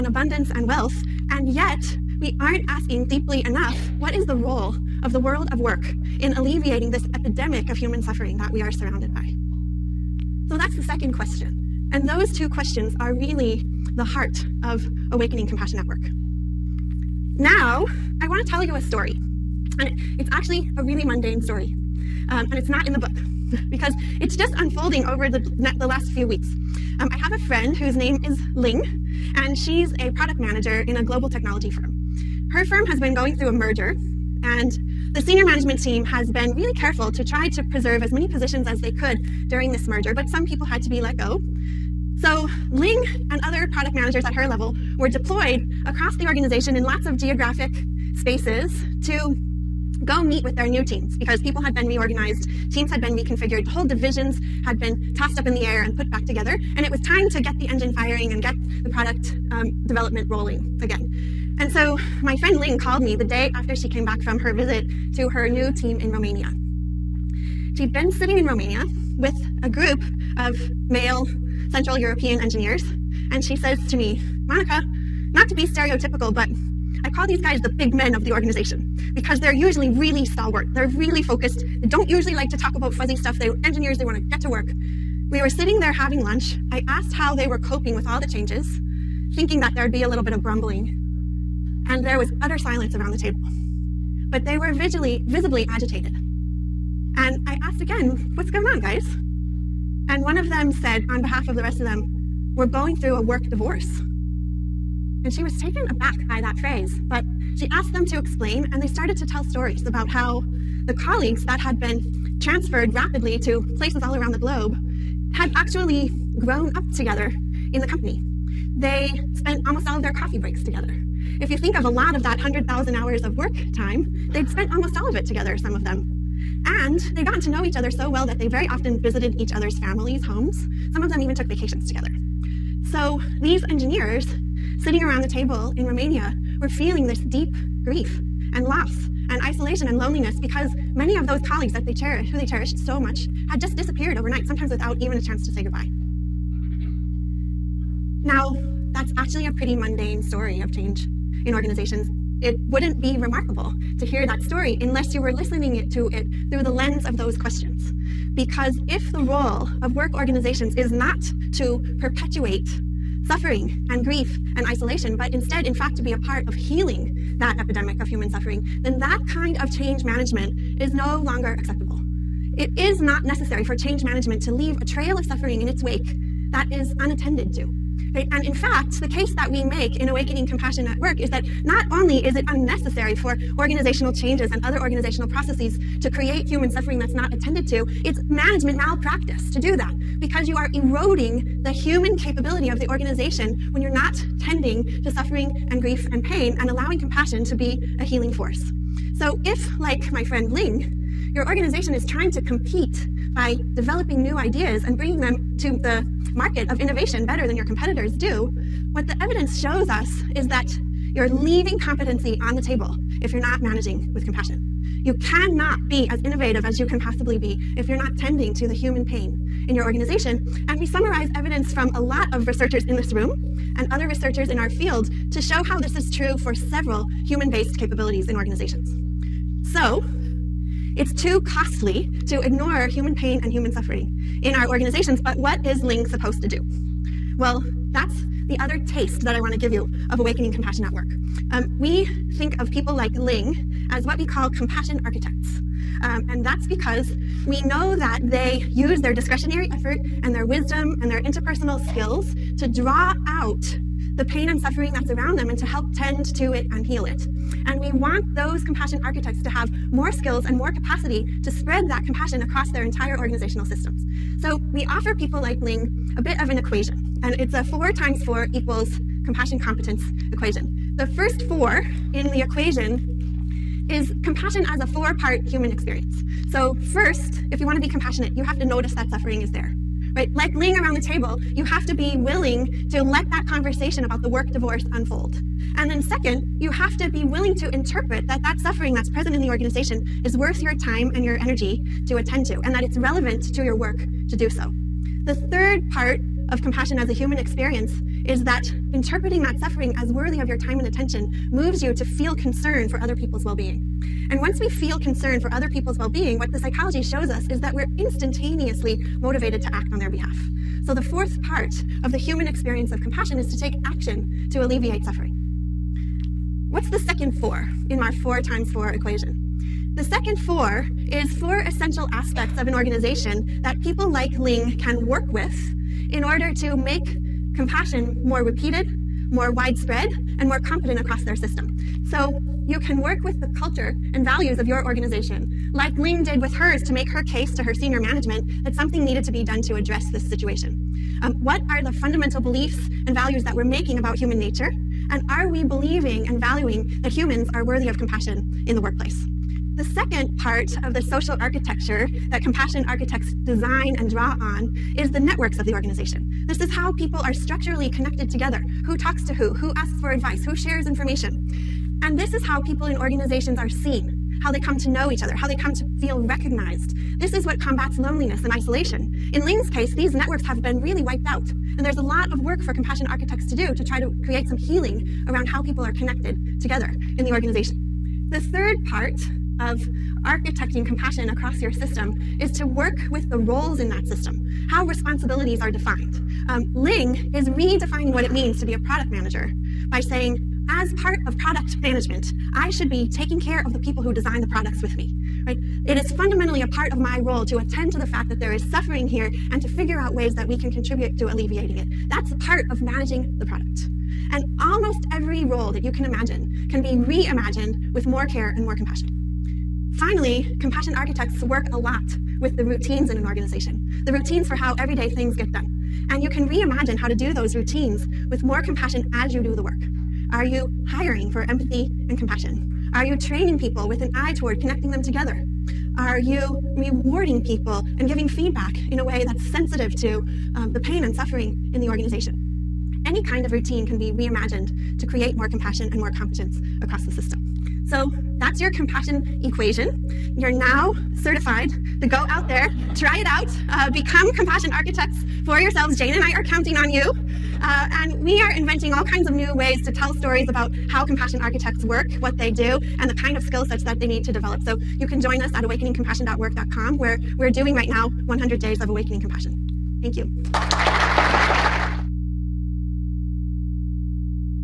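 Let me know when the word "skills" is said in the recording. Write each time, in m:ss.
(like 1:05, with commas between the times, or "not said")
4:11, 4:20, 7:33.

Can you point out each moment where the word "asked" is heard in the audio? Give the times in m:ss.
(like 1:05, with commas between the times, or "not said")
1:26, 1:37, 1:47.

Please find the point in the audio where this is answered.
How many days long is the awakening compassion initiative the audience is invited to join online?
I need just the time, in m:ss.
7:38.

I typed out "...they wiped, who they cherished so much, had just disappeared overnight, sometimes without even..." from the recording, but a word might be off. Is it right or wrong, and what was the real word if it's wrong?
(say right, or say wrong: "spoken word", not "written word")
wrong: "cherished", not "wiped".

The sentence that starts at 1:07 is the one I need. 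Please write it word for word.
She'd been sitting in Romania with a group of male Central European engineers.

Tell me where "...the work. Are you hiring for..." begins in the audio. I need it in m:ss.
6:59.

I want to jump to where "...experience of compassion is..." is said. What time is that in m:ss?
5:12.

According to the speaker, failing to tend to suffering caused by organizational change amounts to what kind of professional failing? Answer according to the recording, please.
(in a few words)
management malpractice.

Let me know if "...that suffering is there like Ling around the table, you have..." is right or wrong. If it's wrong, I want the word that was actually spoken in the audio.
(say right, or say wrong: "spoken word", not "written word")
right.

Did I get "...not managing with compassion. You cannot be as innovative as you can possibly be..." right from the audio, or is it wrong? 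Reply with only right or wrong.
right.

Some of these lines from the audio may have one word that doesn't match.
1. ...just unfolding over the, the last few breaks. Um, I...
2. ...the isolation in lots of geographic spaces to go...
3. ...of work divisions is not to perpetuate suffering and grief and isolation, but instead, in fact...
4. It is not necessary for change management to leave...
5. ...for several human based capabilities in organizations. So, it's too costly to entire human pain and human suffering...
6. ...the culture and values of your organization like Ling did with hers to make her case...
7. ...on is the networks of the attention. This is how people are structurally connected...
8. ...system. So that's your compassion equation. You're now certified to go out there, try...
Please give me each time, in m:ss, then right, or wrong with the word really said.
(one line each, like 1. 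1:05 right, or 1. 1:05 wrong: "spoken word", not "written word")
1. 0:24 wrong: "weeks", not "breaks"
2. 0:46 wrong: "organization", not "isolation"
3. 2:39 wrong: "organizations", not "divisions"
4. 2:52 right
5. 3:46 wrong: "ignore", not "entire"
6. 5:33 right
7. 5:54 wrong: "organization", not "attention"
8. 7:17 right.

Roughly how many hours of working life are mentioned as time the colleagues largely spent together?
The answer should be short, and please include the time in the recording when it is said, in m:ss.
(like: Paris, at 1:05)
100,000, at 2:02.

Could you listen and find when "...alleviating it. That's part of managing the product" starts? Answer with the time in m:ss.
6:41.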